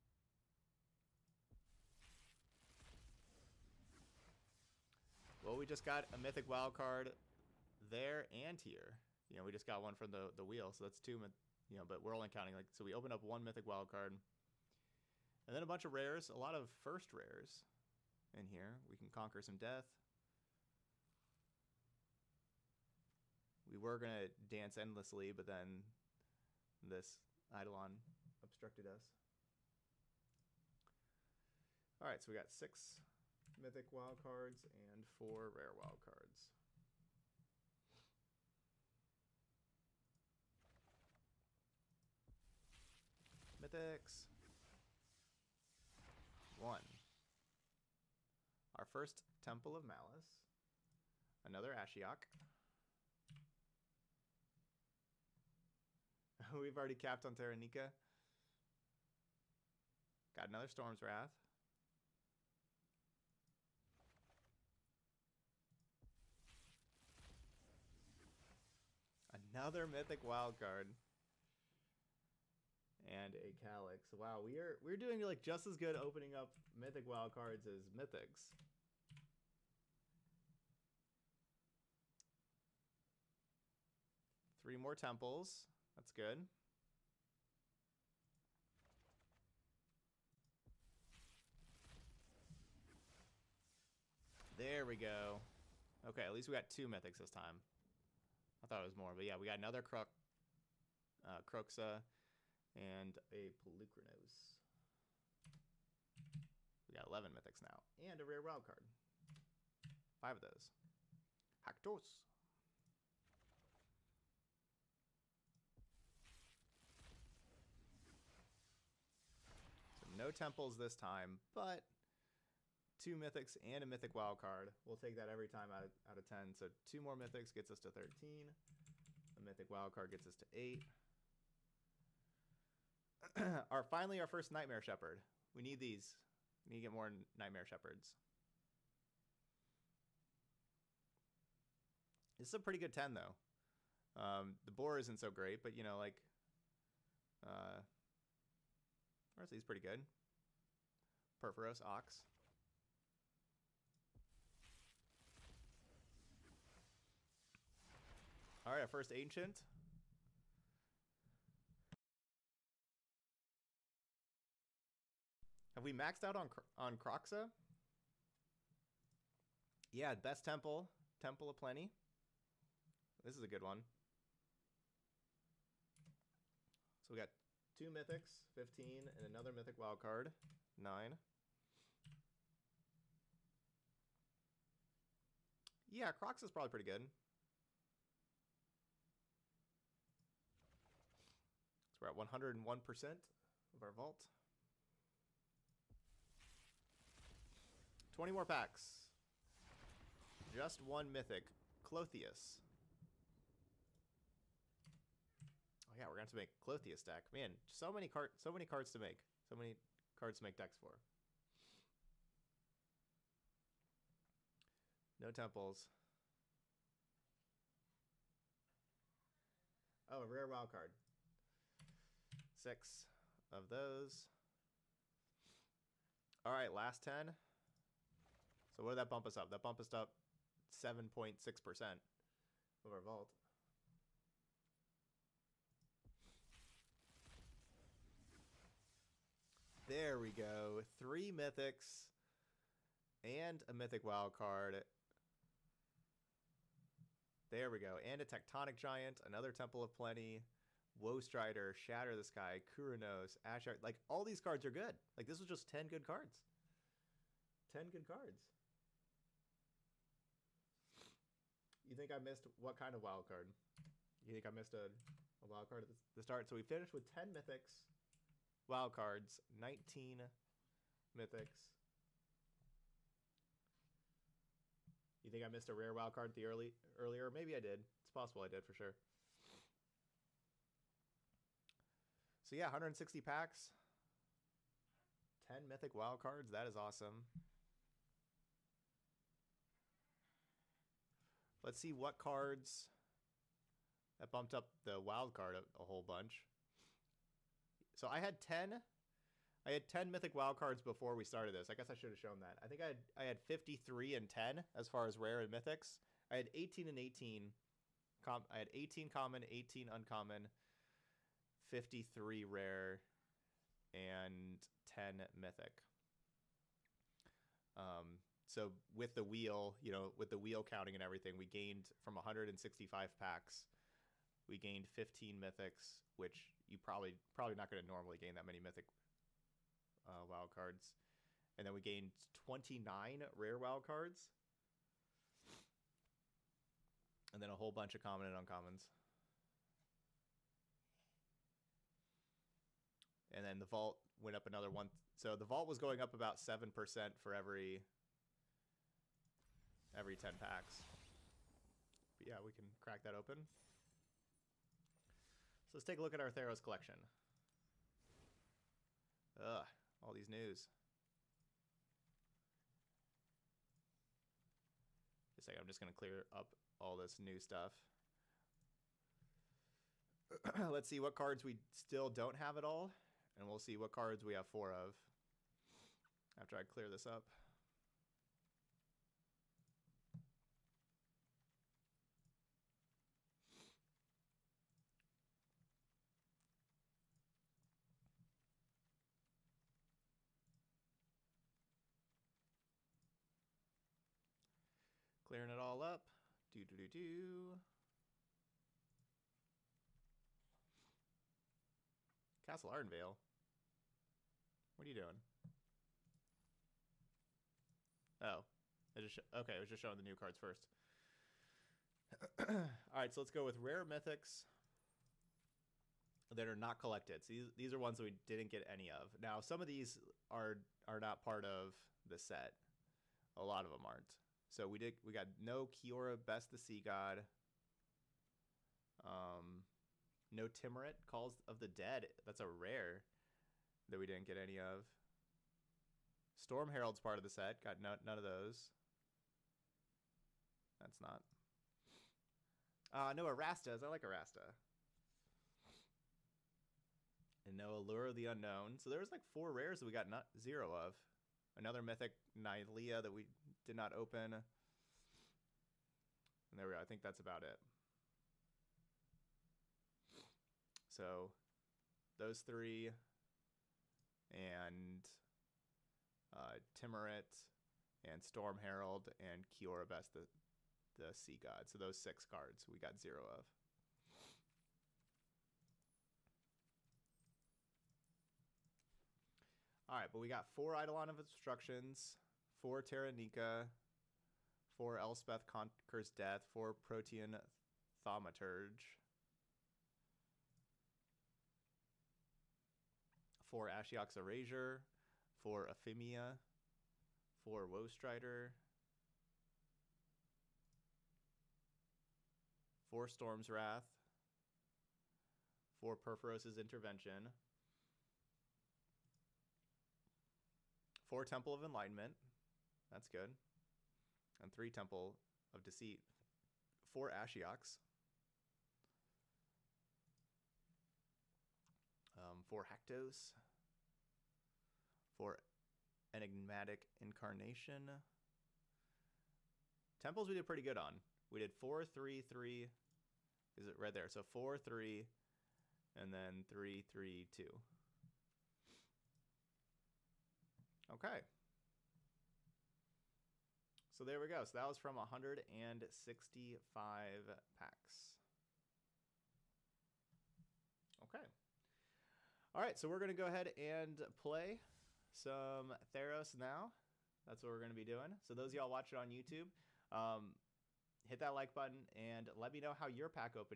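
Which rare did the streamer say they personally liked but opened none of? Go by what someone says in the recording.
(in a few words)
Arasta.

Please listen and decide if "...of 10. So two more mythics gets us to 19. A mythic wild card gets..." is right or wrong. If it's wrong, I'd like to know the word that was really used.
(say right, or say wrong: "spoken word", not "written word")
wrong: "13", not "19".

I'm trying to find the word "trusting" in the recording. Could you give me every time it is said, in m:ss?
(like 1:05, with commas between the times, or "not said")
not said.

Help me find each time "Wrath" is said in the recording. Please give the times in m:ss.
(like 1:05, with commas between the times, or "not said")
1:01, 8:23.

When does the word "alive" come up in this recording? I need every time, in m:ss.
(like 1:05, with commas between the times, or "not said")
not said.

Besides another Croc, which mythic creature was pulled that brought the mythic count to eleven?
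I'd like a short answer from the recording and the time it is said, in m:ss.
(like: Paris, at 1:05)
Polukranos, at 1:43.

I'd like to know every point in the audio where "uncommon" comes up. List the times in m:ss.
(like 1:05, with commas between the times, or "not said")
5:09, 5:38.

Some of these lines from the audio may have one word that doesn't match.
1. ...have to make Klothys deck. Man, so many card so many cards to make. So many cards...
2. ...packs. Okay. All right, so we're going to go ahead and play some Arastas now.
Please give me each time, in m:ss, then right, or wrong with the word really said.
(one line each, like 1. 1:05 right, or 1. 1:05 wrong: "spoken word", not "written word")
1. 3:26 right
2. 9:07 wrong: "Theros", not "Arastas".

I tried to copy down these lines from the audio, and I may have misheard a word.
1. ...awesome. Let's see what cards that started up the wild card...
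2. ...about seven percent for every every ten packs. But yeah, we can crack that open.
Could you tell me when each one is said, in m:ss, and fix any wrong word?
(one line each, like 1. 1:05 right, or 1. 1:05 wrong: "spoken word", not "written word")
1. 4:46 wrong: "bumped", not "started"
2. 5:46 right.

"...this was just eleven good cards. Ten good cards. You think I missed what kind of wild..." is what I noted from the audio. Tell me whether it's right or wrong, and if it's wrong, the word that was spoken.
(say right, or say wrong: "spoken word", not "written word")
wrong: "ten", not "eleven".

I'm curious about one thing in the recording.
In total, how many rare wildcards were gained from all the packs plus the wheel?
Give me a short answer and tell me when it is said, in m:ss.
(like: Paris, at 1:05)
29, at 5:32.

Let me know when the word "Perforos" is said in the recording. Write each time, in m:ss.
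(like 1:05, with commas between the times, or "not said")
2:31.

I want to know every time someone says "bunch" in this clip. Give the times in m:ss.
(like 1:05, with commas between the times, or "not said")
0:15, 4:56, 5:37.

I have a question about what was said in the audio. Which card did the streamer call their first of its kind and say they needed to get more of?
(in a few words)
Nightmare Shepherd.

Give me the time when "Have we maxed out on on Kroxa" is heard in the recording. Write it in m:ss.
2:45.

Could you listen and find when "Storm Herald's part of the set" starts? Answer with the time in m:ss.
7:16.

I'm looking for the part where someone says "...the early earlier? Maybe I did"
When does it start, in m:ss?
4:36.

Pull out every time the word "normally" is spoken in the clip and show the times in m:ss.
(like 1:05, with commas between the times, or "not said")
5:27.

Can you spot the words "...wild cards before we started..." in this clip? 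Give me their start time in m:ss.
5:00.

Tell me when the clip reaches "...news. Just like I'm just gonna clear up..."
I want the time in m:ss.
6:00.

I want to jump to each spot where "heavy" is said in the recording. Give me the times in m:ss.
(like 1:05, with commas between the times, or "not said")
not said.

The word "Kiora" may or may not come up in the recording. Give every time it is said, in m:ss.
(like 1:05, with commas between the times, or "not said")
7:05, 7:49.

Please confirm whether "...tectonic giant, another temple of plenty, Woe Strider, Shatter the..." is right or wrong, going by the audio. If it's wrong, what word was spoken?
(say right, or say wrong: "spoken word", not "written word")
right.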